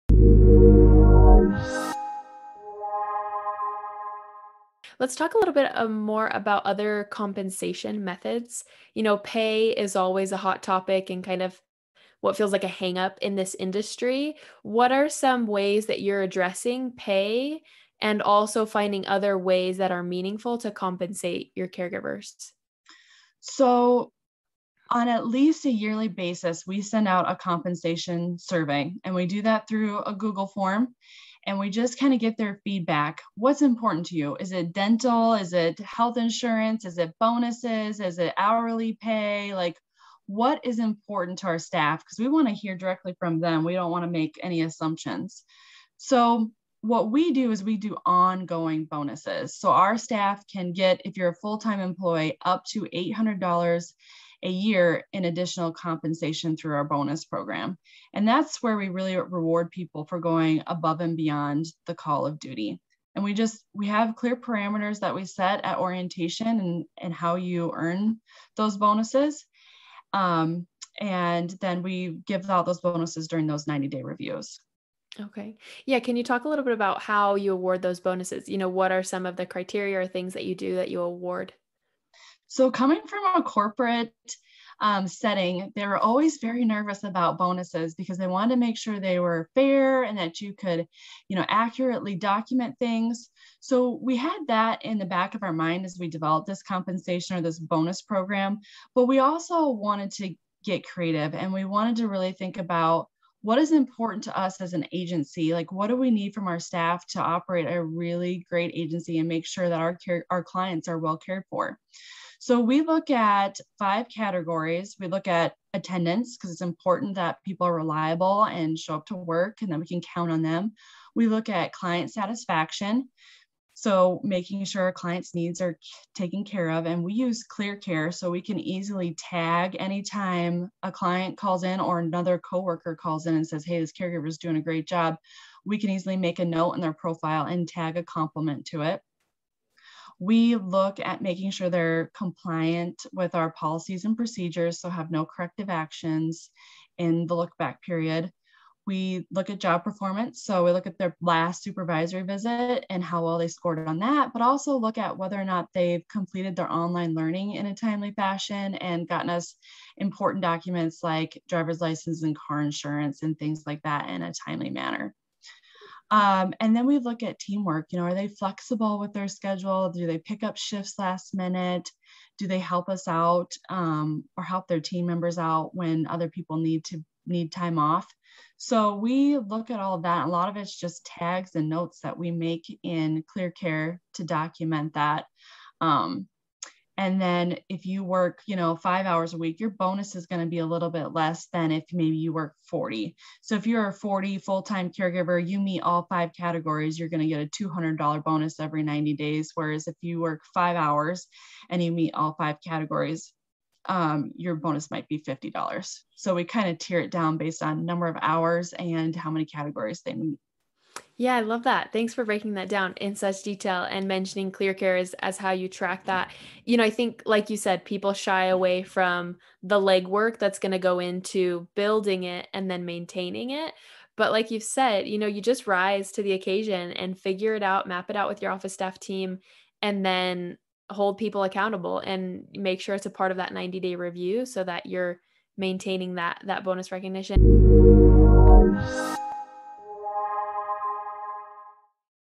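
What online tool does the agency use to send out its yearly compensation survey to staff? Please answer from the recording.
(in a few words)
Google form.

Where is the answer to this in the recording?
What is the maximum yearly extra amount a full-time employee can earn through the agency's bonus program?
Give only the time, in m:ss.
0:52.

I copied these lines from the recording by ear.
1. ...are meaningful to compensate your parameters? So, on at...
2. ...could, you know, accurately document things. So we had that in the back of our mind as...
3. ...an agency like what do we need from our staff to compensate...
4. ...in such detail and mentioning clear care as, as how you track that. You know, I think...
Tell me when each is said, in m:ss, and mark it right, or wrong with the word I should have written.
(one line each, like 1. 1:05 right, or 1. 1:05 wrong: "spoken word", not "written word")
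1. 0:19 wrong: "caregivers", not "parameters"
2. 1:30 right
3. 1:44 wrong: "operate", not "compensate"
4. 3:32 right.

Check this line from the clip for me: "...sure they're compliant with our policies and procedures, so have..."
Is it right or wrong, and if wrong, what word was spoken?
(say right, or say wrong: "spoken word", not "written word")
right.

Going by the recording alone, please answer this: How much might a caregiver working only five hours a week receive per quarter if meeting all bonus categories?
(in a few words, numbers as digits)
$50.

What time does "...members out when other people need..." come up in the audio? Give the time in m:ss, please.
2:55.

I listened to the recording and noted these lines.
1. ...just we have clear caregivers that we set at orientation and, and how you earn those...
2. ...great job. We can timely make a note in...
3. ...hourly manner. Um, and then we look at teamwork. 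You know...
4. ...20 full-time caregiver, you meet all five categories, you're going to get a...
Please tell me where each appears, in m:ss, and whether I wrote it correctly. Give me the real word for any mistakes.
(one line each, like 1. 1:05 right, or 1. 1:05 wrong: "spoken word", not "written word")
1. 1:03 wrong: "parameters", not "caregivers"
2. 2:14 wrong: "easily", not "timely"
3. 2:44 wrong: "timely", not "hourly"
4. 3:13 wrong: "40", not "20".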